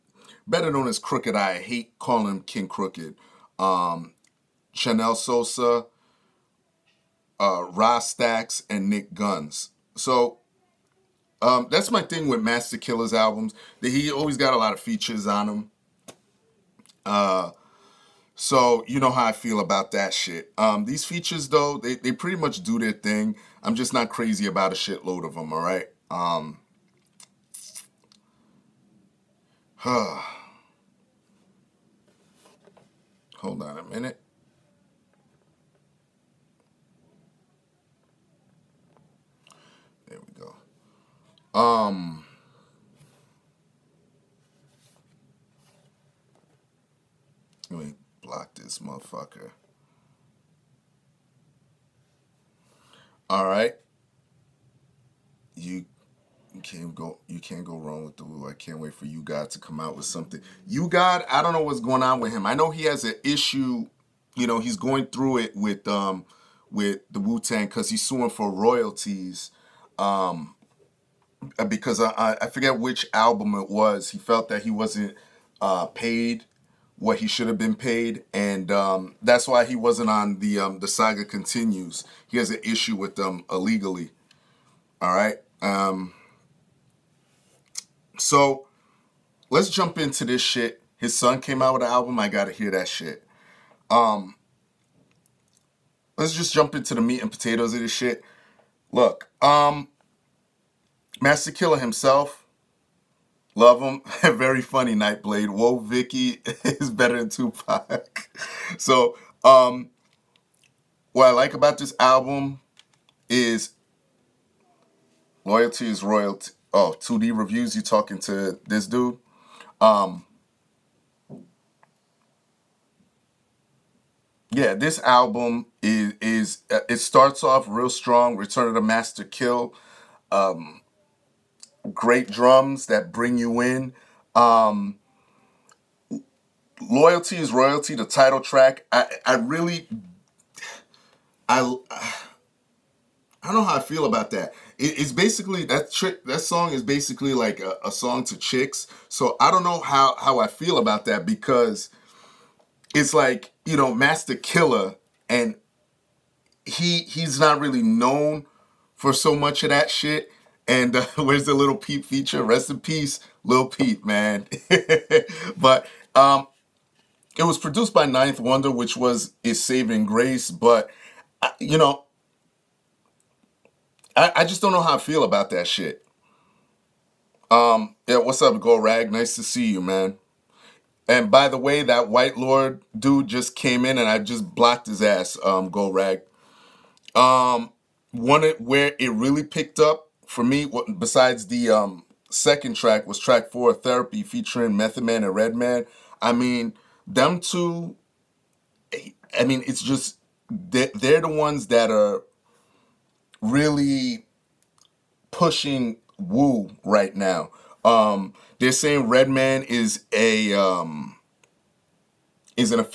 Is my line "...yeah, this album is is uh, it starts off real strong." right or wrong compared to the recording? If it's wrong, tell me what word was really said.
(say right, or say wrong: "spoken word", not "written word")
right.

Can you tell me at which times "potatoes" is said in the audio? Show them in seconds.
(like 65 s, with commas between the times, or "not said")
97 s.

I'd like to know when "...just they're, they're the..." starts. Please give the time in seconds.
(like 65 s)
199 s.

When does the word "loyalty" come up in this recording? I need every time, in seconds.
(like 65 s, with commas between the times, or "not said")
115 s, 136 s.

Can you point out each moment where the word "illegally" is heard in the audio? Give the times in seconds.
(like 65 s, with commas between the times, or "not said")
83 s.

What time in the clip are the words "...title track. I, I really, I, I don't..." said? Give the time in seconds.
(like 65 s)
138 s.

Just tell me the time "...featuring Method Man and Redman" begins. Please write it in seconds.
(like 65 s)
194 s.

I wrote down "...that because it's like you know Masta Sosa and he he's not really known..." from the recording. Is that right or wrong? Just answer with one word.
wrong.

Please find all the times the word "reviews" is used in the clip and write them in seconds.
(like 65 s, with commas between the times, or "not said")
117 s.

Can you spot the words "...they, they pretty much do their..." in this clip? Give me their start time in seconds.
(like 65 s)
21 s.